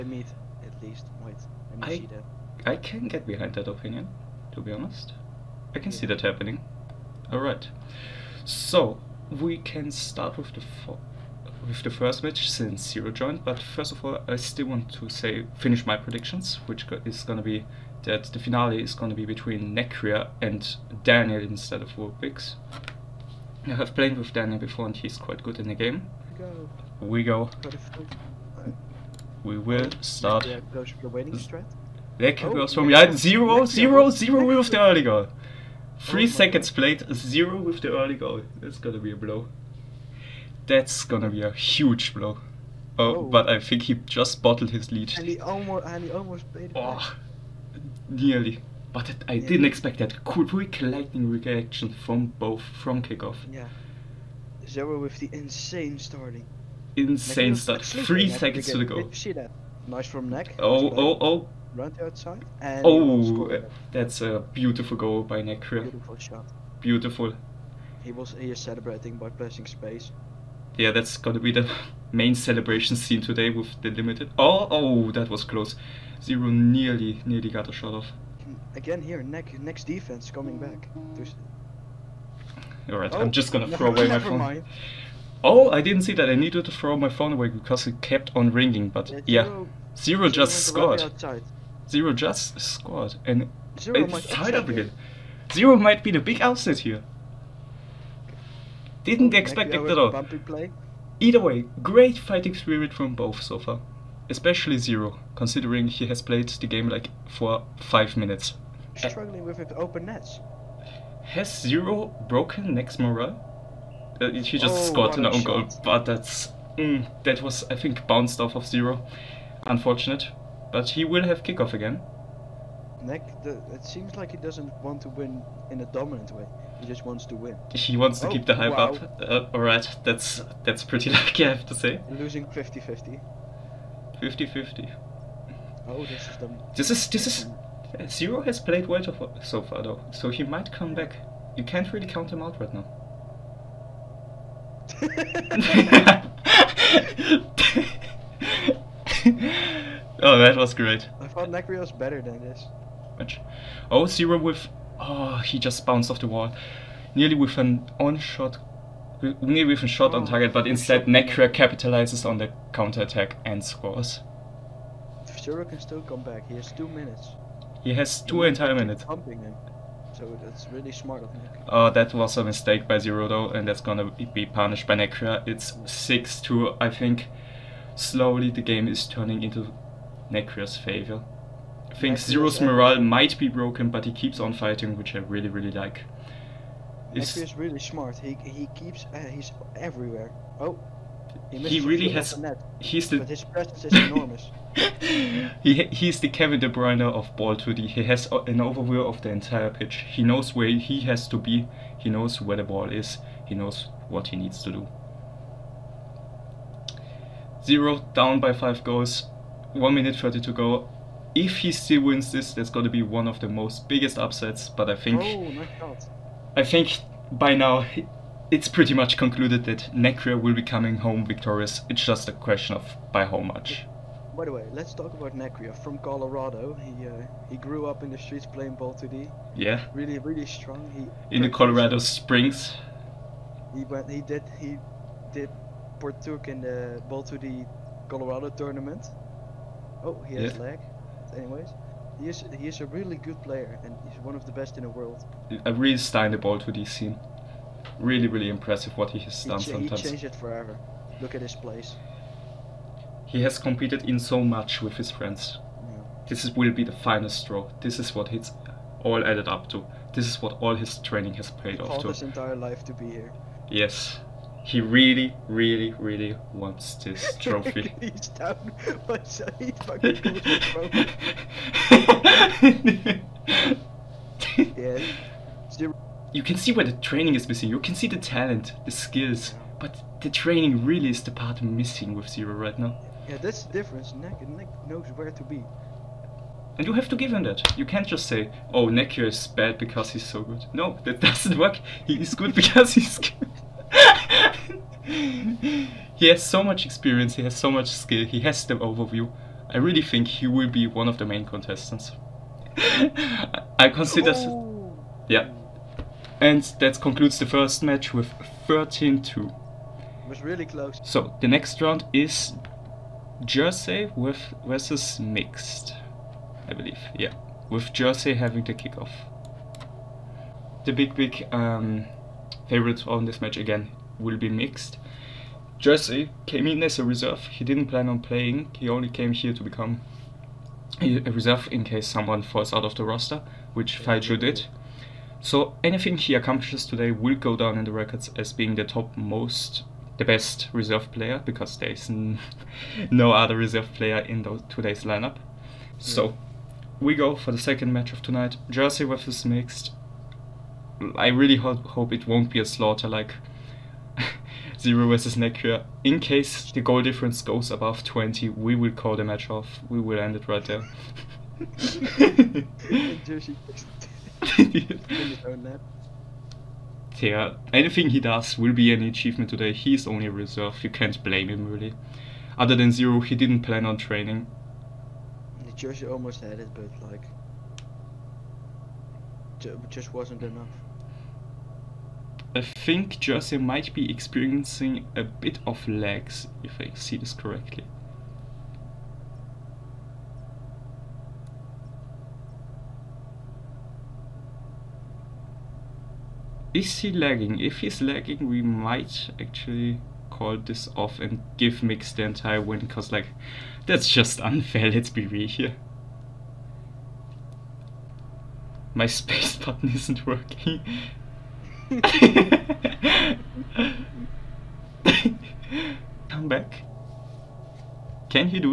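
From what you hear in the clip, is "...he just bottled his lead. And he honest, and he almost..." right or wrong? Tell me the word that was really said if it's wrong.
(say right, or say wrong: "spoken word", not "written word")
wrong: "almost", not "honest".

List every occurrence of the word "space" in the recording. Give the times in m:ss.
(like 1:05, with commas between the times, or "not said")
1:09, 6:49.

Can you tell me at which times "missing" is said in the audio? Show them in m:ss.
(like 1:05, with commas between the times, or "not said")
4:37, 4:41.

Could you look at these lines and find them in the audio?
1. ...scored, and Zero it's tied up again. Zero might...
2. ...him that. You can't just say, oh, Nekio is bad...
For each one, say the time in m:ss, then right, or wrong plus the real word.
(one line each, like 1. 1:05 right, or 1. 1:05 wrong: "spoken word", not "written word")
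1. 1:32 right
2. 4:47 right.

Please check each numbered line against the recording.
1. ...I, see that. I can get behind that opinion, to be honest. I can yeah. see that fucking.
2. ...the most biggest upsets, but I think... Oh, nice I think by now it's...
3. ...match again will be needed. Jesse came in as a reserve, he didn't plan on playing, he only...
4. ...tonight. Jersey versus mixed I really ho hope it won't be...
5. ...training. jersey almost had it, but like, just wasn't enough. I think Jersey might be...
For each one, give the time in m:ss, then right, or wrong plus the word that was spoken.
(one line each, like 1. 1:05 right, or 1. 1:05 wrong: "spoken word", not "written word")
1. 0:01 wrong: "happening", not "fucking"
2. 3:33 right
3. 5:23 wrong: "mixed", not "needed"
4. 5:48 right
5. 6:13 right.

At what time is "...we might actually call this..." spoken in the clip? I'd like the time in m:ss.
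6:38.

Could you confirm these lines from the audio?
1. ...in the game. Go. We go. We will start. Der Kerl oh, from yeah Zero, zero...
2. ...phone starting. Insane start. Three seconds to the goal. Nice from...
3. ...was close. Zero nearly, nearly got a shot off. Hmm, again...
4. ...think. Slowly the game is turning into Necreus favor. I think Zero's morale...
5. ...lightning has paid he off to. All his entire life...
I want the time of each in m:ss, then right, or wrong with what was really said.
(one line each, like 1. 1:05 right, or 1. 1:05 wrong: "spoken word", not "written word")
1. 0:25 right
2. 0:55 wrong: "insane", not "phone"
3. 1:15 right
4. 2:56 right
5. 4:20 wrong: "training", not "lightning".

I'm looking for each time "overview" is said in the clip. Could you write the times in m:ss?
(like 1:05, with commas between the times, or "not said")
3:18, 4:58.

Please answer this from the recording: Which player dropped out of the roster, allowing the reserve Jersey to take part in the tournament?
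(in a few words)
Faiju.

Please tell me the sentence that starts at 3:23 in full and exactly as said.
He knows what he needs to do.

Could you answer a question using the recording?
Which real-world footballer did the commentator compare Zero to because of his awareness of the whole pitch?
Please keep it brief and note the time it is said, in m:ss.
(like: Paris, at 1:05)
Kevin De Bruyne, at 3:16.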